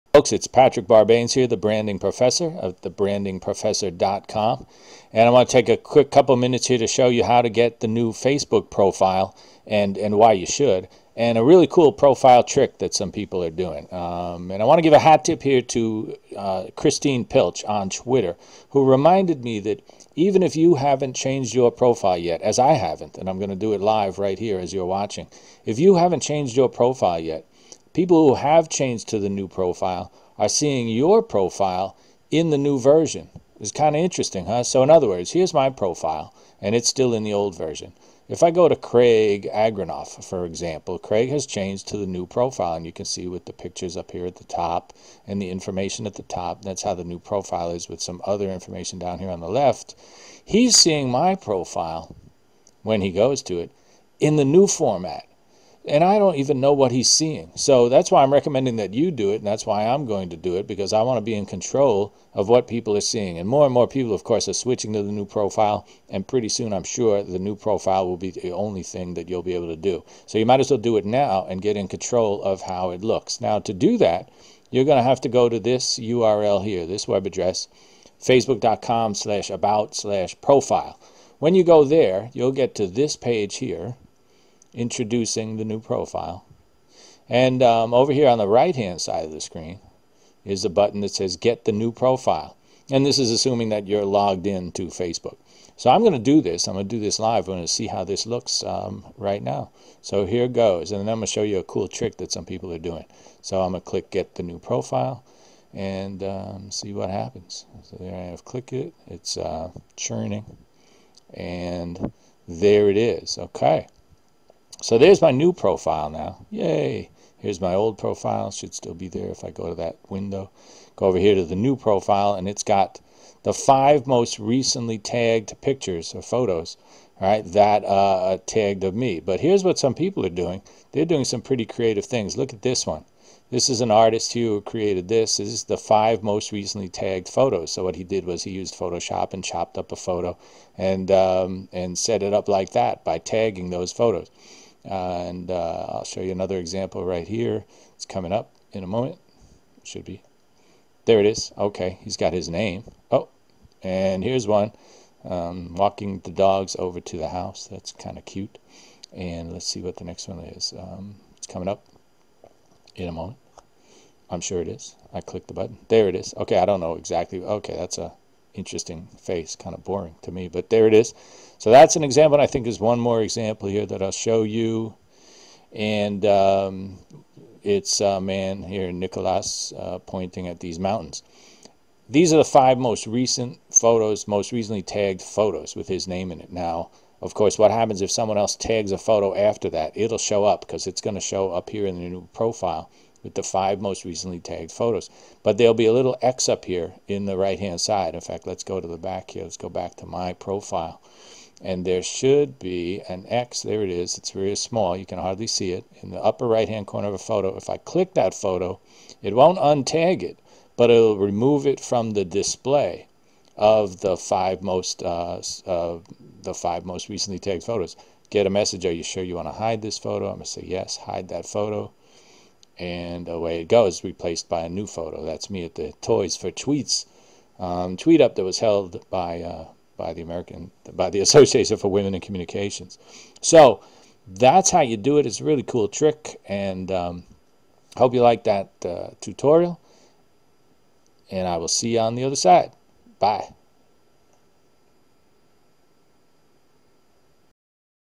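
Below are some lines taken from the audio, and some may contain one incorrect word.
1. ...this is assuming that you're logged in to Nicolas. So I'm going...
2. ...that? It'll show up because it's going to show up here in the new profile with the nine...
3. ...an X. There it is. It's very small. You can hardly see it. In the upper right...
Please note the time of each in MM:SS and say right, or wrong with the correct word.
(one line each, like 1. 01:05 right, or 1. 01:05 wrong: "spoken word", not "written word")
1. 01:33 wrong: "Facebook", not "Nicolas"
2. 03:09 wrong: "five", not "nine"
3. 03:23 right.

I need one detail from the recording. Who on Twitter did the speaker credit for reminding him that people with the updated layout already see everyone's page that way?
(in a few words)
Christine Pilch.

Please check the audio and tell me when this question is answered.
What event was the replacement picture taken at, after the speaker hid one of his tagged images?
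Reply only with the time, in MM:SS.
03:46.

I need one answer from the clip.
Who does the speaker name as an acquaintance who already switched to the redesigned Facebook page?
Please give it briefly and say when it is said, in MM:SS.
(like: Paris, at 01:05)
Craig Agranoff, at 00:38.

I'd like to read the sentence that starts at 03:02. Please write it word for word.
These are the five most recent photos, most recently tagged photos with his name in it.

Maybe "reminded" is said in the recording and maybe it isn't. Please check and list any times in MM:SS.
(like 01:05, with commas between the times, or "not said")
00:18.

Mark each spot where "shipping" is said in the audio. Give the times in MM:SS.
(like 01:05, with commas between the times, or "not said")
not said.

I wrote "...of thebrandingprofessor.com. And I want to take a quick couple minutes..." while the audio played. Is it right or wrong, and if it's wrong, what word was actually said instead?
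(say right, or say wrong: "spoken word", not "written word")
right.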